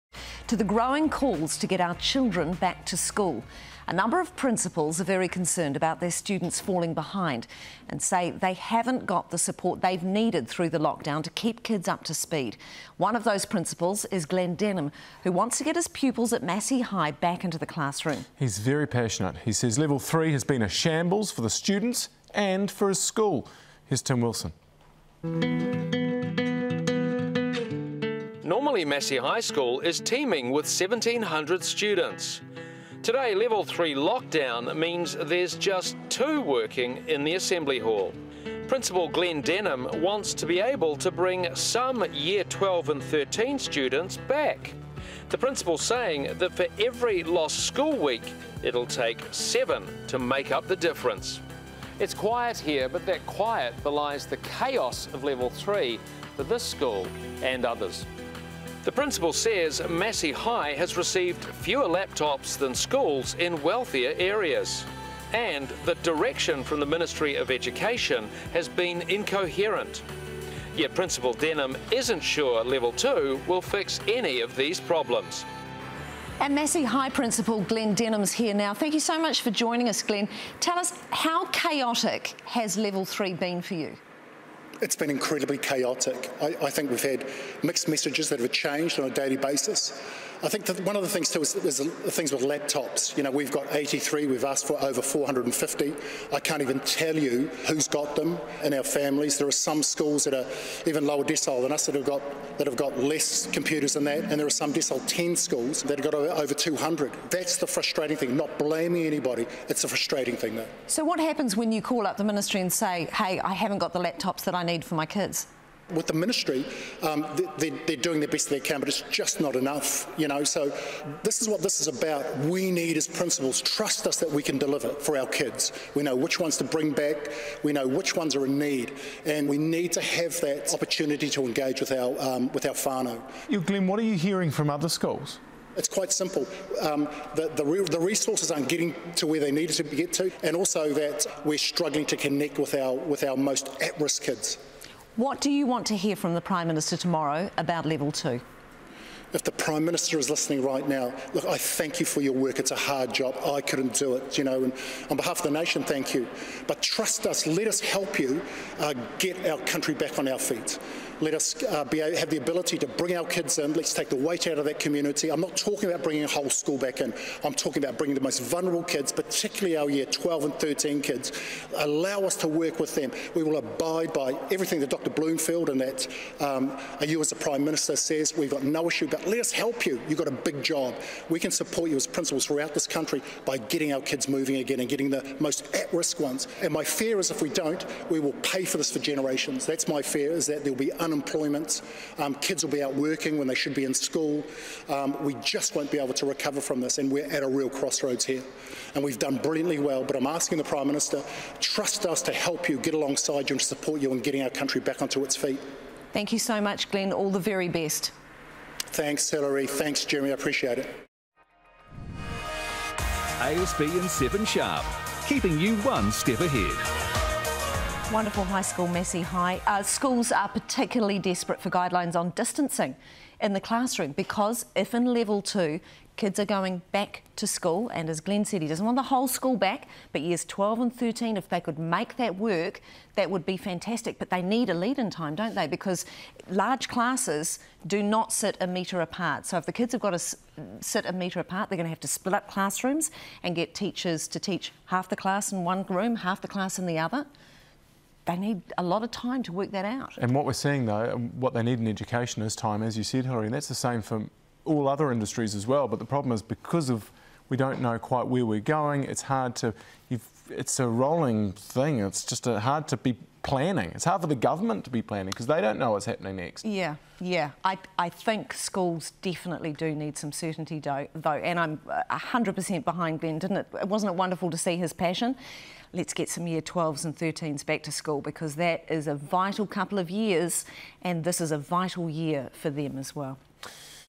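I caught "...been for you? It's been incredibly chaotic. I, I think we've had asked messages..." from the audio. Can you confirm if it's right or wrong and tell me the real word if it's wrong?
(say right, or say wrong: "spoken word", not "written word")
wrong: "mixed", not "asked".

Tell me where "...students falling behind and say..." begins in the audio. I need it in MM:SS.
00:06.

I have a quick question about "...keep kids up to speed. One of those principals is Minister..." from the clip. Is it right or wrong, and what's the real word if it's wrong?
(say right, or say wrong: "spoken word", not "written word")
wrong: "Glen", not "Minister".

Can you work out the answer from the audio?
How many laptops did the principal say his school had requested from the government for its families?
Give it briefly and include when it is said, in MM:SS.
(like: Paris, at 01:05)
over 450, at 01:34.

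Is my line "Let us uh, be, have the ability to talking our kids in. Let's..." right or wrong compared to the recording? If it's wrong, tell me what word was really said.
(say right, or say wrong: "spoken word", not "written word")
wrong: "bring", not "talking".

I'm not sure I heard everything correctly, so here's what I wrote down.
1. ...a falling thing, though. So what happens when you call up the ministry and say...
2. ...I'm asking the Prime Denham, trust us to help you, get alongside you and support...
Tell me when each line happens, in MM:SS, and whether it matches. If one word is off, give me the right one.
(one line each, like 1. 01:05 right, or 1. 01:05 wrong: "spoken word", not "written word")
1. 01:49 wrong: "frustrating", not "falling"
2. 03:20 wrong: "Minister", not "Denham".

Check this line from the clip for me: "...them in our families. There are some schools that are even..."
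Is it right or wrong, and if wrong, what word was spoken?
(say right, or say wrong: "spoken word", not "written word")
right.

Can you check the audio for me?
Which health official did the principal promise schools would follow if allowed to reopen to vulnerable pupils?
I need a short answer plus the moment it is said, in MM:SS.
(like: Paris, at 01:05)
Dr. Bloomfield, at 02:54.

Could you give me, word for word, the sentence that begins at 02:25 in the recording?
What do you want to hear from the Prime Minister tomorrow about level two?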